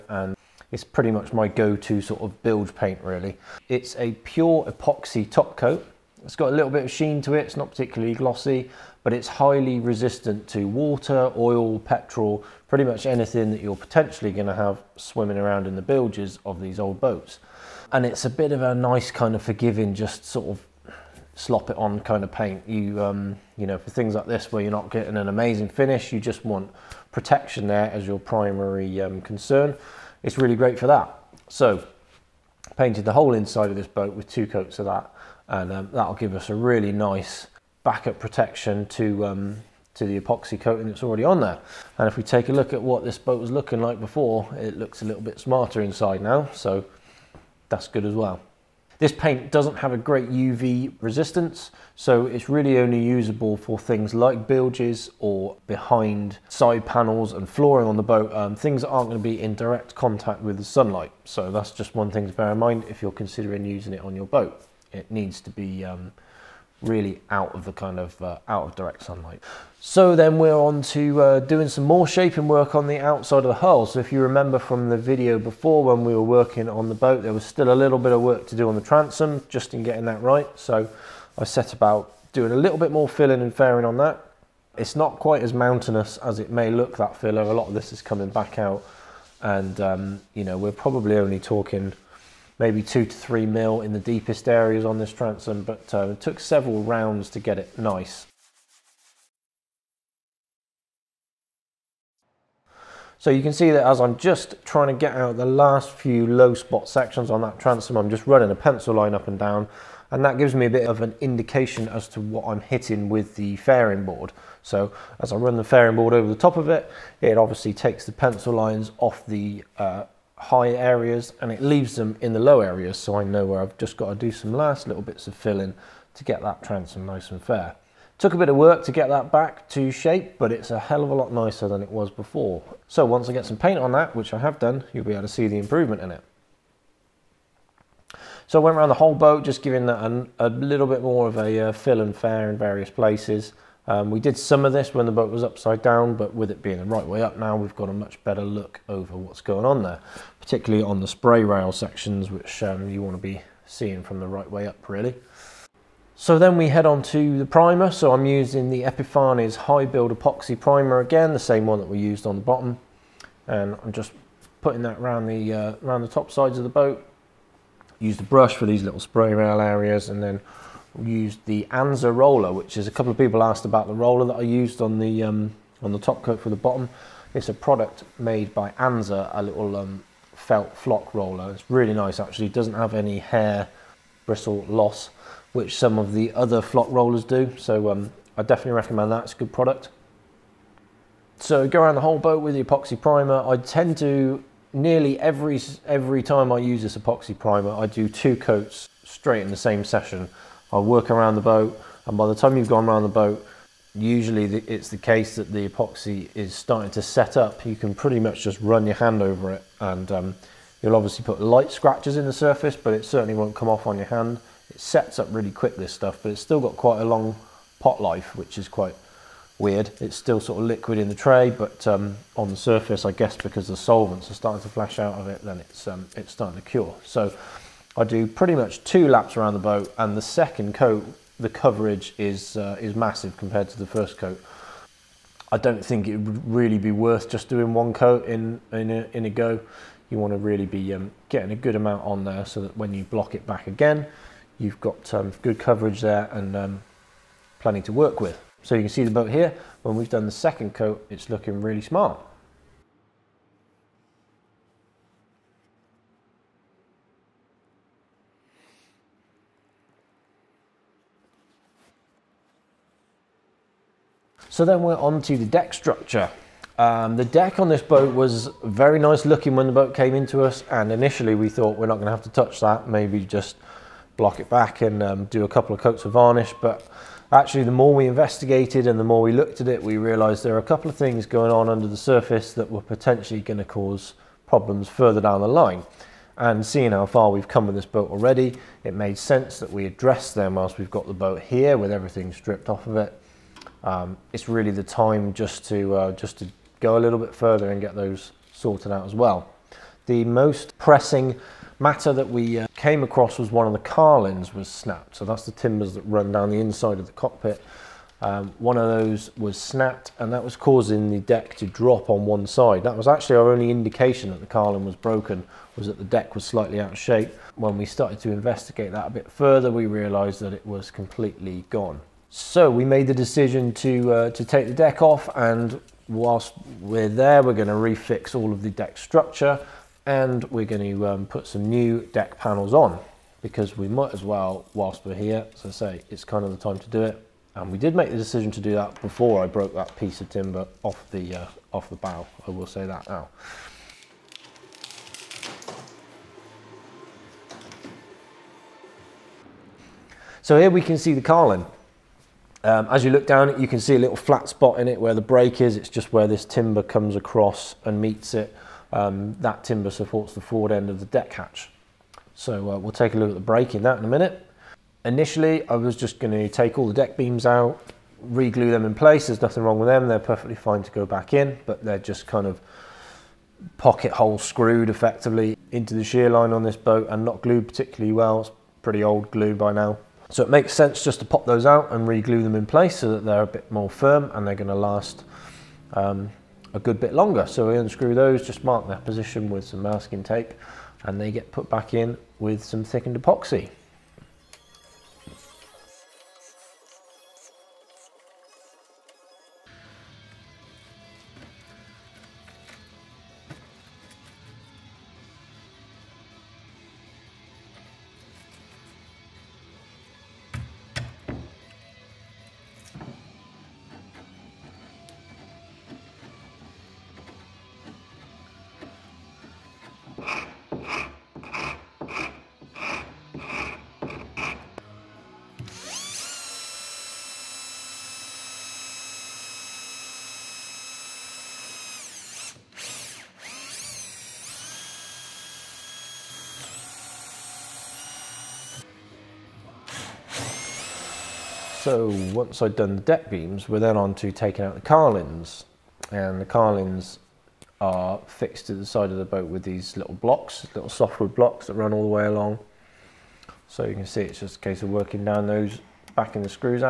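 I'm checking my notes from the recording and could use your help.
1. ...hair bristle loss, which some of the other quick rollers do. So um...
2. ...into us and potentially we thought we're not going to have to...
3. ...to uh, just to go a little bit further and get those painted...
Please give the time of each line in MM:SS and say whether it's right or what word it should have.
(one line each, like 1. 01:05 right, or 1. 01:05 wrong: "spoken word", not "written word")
1. 03:03 wrong: "flock", not "quick"
2. 04:30 wrong: "initially", not "potentially"
3. 04:55 wrong: "sorted", not "painted".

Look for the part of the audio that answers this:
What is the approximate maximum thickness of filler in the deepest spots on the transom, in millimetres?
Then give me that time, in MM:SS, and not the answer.
01:32.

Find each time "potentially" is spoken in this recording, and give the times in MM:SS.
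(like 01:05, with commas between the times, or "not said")
00:13, 04:42.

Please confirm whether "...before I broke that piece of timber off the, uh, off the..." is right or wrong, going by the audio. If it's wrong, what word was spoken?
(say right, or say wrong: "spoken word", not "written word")
right.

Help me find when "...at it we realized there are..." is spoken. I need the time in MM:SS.
04:39.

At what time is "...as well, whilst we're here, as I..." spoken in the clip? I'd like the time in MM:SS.
05:34.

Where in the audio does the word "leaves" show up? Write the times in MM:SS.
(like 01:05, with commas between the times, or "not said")
02:01.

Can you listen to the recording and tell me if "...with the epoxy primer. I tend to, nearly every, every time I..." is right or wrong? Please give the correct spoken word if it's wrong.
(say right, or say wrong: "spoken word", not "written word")
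right.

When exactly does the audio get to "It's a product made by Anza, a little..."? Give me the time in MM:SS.
02:57.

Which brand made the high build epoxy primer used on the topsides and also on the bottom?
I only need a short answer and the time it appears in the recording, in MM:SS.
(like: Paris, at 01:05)
Epifanes, at 02:38.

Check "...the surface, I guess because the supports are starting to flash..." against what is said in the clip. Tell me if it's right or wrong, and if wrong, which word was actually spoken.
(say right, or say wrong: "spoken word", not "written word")
wrong: "solvents", not "supports".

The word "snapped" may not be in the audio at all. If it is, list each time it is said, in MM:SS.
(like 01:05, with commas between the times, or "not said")
05:04, 05:09.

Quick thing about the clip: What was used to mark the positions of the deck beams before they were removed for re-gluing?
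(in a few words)
Masking tape.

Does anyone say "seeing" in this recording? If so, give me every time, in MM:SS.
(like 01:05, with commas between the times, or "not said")
02:33, 04:46.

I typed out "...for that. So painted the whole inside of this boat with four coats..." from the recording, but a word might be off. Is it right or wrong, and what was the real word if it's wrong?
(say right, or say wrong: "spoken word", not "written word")
wrong: "two", not "four".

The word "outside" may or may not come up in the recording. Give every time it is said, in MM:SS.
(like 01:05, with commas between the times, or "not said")
01:12.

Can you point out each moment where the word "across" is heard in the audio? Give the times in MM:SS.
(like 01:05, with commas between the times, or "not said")
05:03, 05:57.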